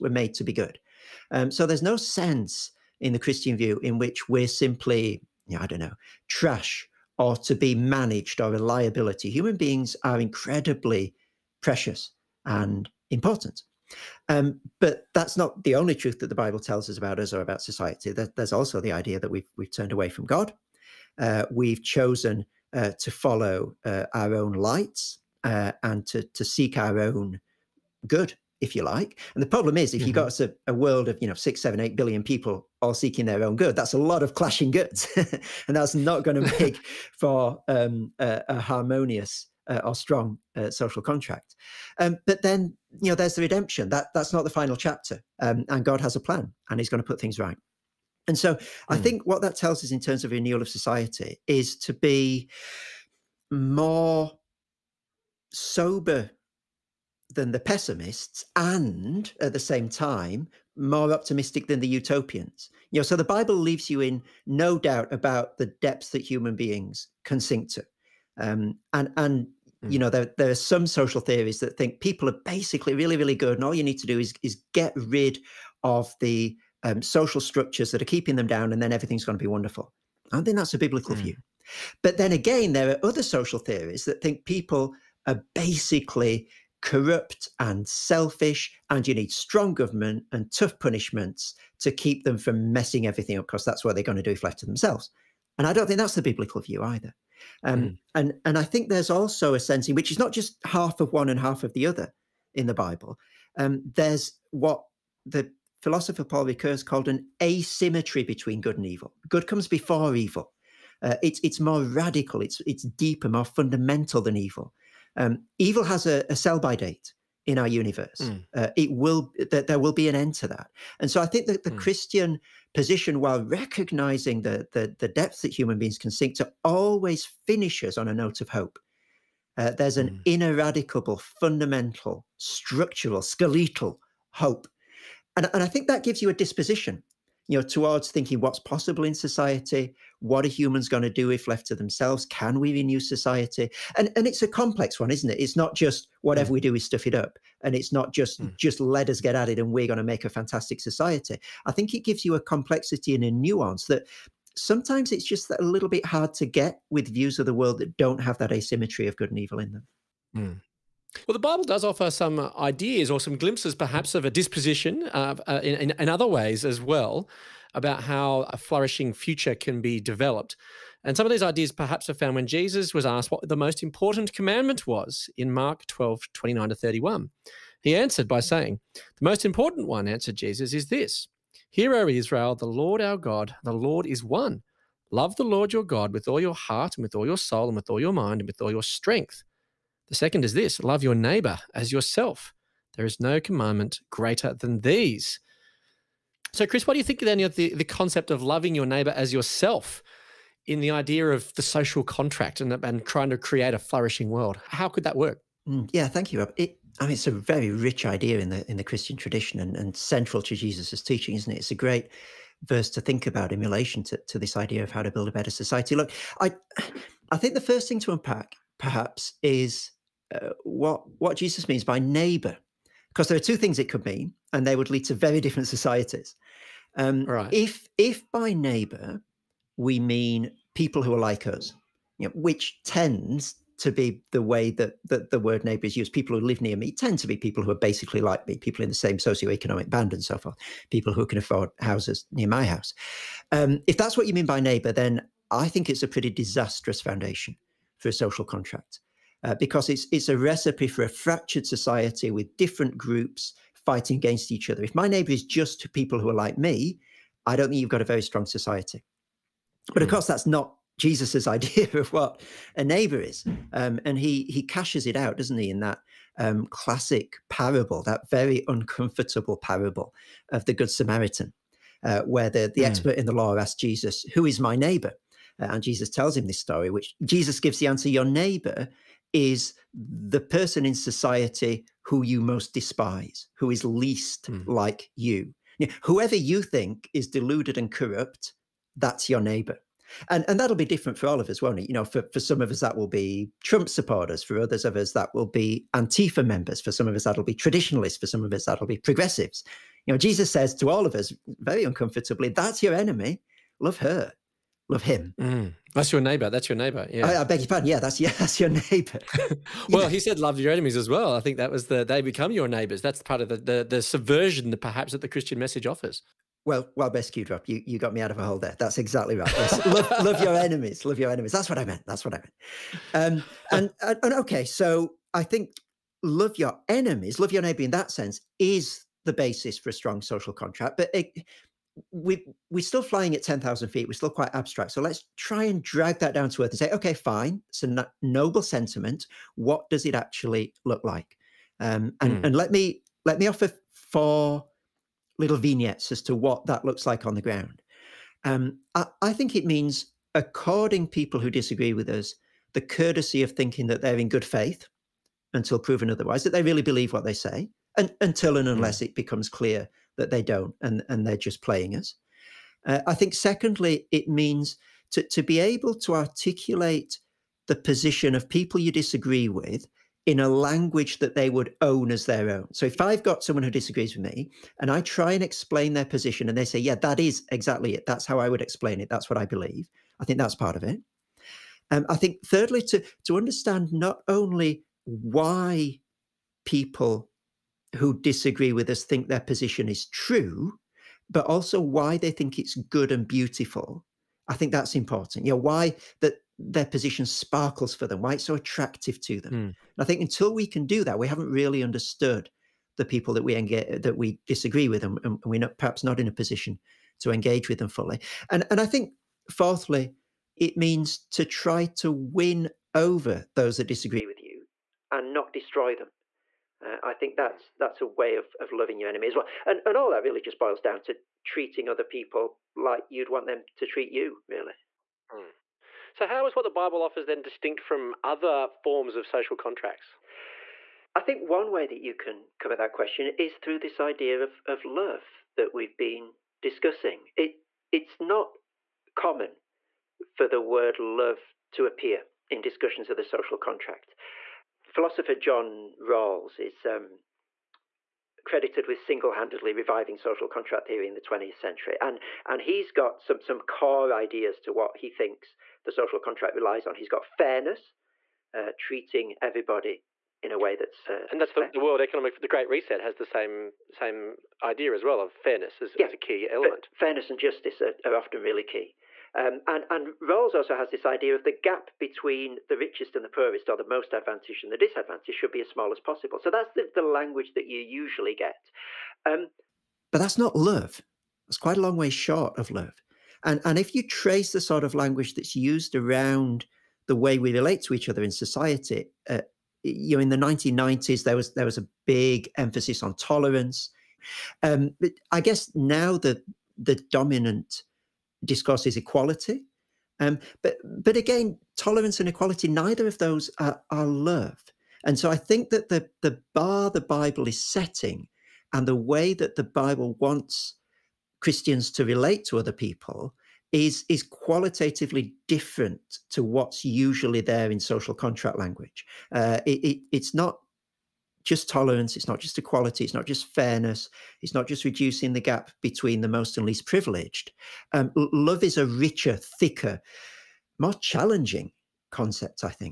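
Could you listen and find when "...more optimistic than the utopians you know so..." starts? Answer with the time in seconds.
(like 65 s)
60 s.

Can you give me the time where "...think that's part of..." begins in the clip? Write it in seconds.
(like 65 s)
380 s.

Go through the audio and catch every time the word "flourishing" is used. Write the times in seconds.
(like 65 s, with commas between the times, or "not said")
168 s, 203 s.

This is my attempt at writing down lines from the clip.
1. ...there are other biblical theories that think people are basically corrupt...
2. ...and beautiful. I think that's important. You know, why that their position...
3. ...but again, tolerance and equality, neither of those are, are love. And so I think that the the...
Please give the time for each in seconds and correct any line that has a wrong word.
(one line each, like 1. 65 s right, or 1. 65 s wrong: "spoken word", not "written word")
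1. 82 s wrong: "social", not "biblical"
2. 393 s right
3. 501 s right.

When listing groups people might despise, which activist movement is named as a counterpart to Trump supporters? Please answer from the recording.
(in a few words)
Antifa.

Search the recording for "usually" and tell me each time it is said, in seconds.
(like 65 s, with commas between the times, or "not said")
477 s, 516 s.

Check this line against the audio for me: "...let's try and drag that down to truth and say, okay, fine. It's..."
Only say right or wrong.
wrong.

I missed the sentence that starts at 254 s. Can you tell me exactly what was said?
If my neighbor is just people who are like me, I don't think you've got a very strong society.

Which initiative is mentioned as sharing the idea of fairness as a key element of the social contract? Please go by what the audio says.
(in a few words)
The Great Reset.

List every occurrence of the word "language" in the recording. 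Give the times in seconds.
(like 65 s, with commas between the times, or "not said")
370 s, 477 s, 484 s, 518 s.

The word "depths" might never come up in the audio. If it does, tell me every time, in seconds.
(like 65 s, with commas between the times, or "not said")
65 s, 125 s.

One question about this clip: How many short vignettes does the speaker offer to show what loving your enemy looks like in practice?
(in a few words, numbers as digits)
4.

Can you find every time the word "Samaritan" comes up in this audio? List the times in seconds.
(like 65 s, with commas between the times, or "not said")
270 s.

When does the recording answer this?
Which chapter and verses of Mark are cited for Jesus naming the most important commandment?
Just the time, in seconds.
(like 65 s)
175 s.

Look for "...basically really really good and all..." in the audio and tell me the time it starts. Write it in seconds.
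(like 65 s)
72 s.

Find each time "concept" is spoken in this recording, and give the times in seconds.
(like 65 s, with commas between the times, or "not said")
197 s, 532 s.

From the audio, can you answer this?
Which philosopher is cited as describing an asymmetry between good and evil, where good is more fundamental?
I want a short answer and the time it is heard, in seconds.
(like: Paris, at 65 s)
Paul Ricoeur, at 106 s.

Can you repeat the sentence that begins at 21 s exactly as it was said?
Uh, we've chosen uh, to follow uh, our own lights uh, and to, to seek our own good if you like.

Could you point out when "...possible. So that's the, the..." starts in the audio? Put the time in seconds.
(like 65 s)
475 s.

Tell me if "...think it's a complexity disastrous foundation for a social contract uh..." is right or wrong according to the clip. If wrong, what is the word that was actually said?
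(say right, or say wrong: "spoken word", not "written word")
wrong: "pretty", not "complexity".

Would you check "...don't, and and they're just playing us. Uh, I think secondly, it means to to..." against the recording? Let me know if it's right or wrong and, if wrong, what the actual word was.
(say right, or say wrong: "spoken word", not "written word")
right.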